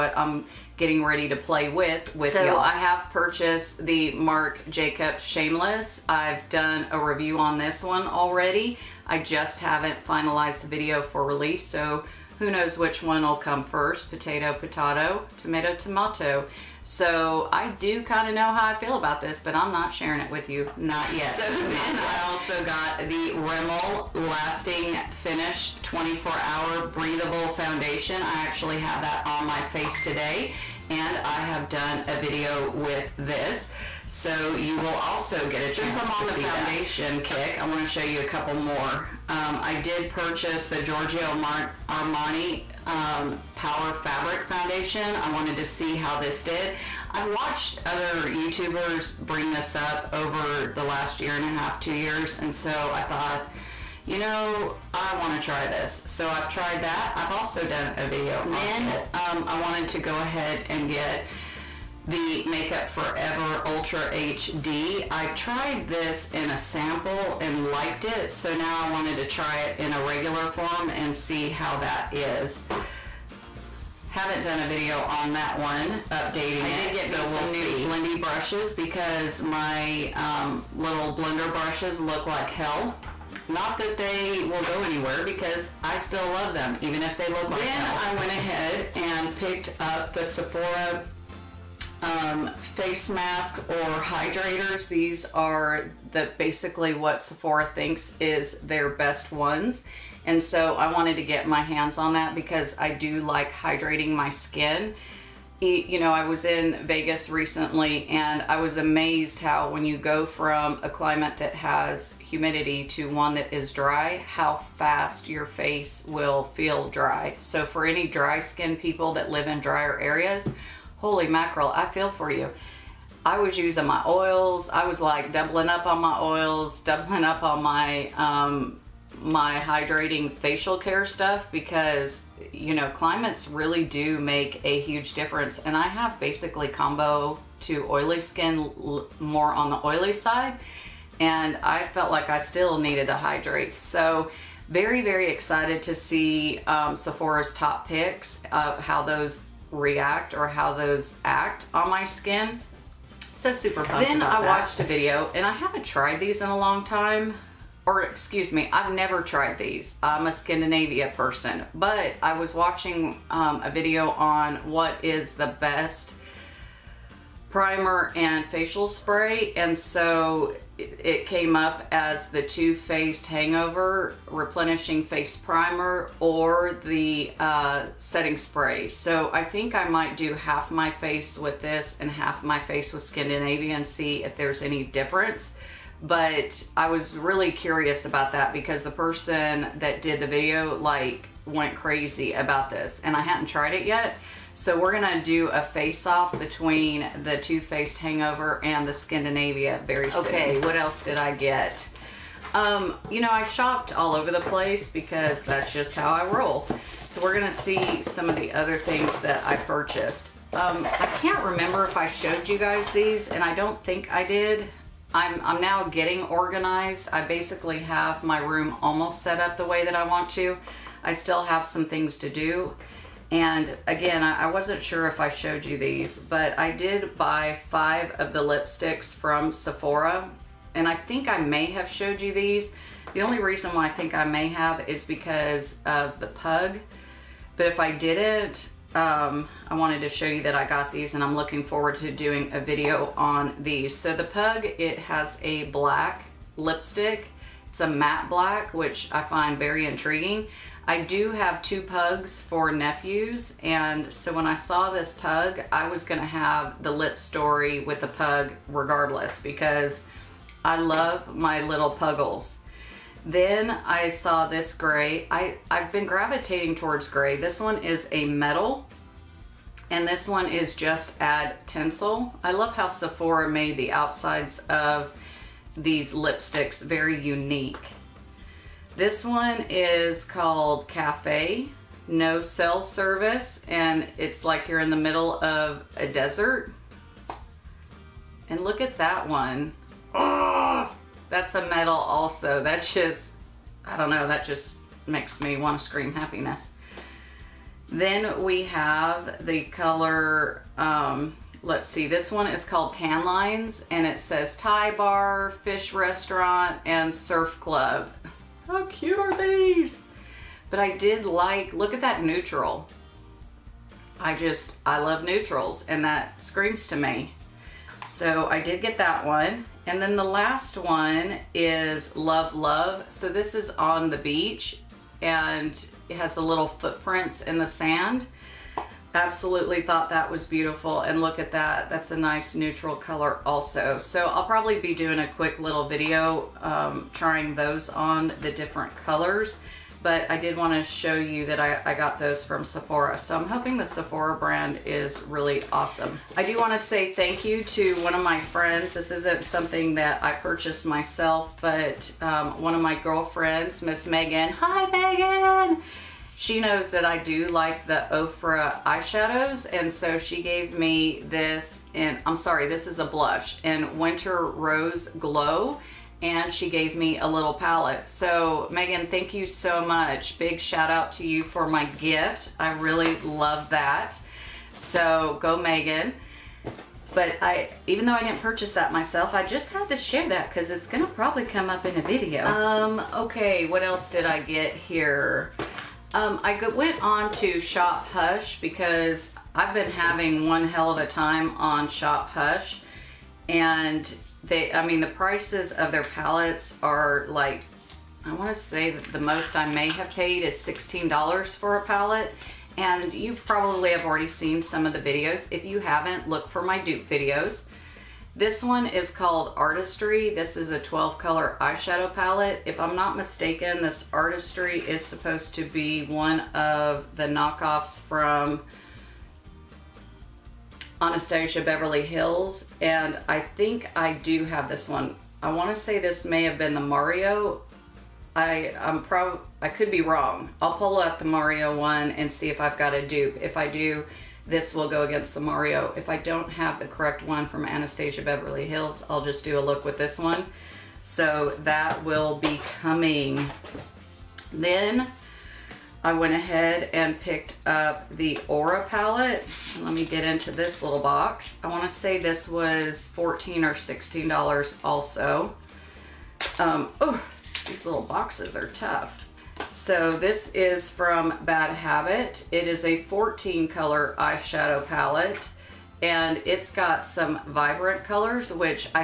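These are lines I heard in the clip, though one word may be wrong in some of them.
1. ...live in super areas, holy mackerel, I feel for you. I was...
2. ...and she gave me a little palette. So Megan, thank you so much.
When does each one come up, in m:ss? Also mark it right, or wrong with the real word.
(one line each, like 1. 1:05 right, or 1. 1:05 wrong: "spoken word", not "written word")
1. 1:59 wrong: "drier", not "super"
2. 6:06 right.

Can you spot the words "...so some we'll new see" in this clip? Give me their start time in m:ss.
1:17.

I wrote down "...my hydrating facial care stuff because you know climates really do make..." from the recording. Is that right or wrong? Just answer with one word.
right.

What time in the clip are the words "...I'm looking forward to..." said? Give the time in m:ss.
4:01.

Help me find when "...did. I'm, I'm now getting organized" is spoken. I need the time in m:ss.
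3:34.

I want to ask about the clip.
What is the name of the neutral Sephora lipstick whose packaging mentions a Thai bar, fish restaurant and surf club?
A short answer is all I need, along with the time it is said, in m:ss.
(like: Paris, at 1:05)
Tan Lines, at 5:02.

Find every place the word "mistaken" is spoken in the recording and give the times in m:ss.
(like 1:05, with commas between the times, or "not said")
6:53.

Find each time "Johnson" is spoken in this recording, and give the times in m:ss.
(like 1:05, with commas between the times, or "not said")
not said.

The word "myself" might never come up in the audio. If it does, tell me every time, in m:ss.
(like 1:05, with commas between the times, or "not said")
5:50, 6:18.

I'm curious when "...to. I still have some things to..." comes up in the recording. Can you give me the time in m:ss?
3:40.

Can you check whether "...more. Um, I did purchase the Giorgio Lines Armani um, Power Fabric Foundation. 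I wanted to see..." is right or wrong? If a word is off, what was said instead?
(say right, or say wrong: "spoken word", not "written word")
wrong: "Mar", not "Lines".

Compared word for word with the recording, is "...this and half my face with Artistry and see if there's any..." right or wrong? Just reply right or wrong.
wrong.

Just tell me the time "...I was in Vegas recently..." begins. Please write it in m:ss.
1:46.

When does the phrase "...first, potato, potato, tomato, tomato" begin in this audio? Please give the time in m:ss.
0:13.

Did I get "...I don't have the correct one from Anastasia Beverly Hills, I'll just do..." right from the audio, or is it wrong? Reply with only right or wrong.
right.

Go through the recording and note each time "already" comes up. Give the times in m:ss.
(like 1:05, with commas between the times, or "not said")
0:08, 6:44.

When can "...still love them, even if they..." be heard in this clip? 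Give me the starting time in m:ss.
1:25.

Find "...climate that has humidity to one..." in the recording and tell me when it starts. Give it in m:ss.
1:50.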